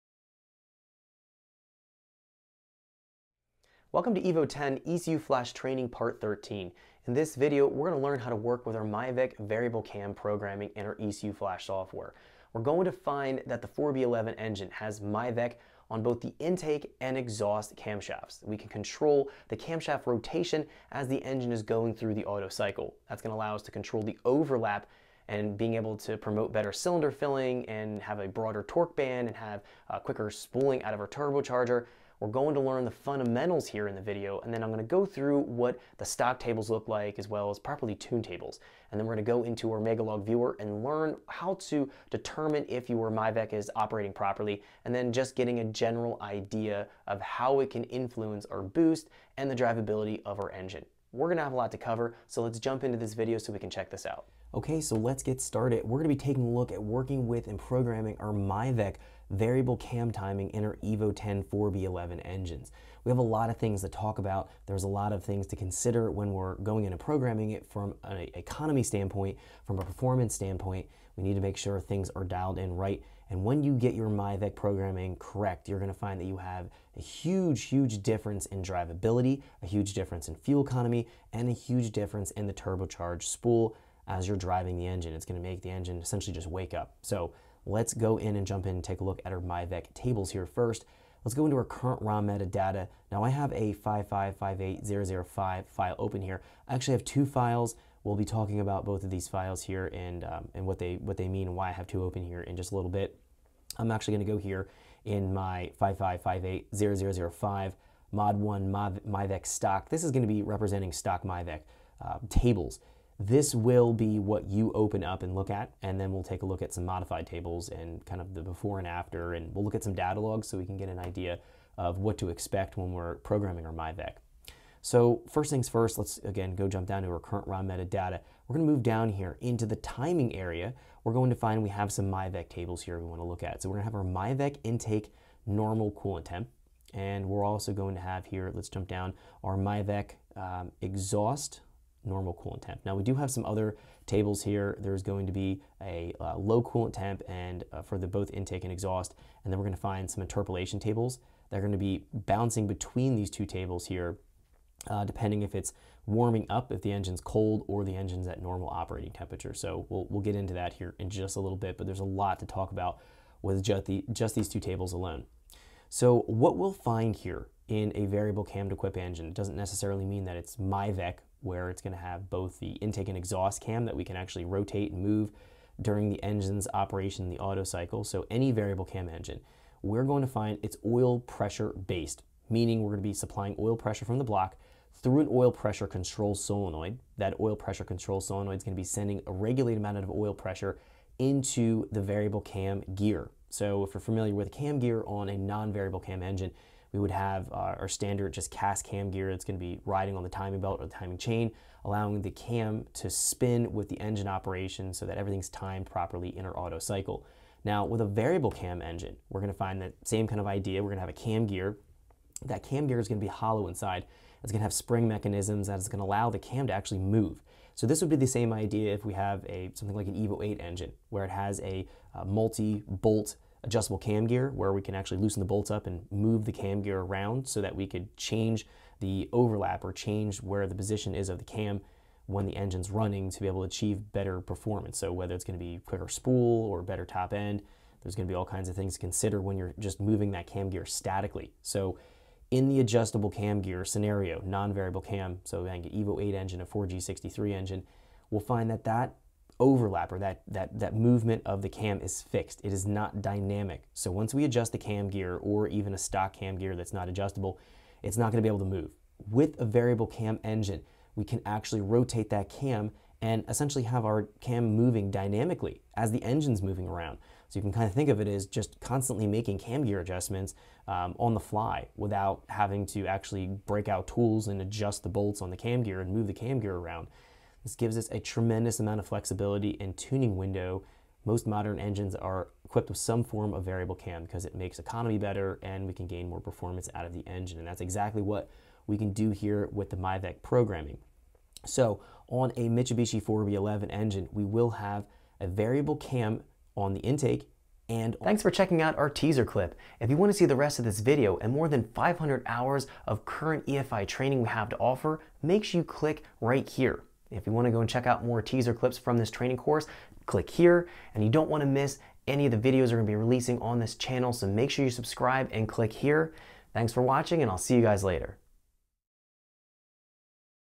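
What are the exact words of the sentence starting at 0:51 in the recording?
We're gonna have a lot to cover, so let's jump into this video so we can check this out.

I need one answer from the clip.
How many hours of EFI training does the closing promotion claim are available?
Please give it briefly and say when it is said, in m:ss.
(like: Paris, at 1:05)
500, at 5:01.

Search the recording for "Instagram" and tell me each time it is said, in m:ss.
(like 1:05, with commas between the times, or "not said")
not said.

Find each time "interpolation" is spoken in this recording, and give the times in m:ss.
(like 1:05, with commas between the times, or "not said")
2:30.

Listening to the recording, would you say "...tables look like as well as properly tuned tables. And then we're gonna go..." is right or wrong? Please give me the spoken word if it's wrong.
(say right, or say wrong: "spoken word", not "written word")
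right.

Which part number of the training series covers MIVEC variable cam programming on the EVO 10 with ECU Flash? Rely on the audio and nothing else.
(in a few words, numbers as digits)
Part 13.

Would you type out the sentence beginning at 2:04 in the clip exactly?
So first things first, let's again go jump down to our current raw metadata.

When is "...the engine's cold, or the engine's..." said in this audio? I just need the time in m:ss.
2:36.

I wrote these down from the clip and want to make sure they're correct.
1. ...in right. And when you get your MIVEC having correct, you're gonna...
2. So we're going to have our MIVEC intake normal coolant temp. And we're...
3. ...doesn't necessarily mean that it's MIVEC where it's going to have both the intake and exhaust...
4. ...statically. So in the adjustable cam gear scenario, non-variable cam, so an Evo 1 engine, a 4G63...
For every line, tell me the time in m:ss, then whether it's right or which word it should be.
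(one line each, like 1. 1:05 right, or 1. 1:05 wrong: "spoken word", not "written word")
1. 1:12 wrong: "programming", not "having"
2. 2:13 right
3. 2:49 right
4. 4:00 wrong: "8", not "1".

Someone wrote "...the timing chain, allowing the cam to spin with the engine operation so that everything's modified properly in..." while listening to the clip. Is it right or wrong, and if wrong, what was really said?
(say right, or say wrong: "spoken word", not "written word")
wrong: "timed", not "modified".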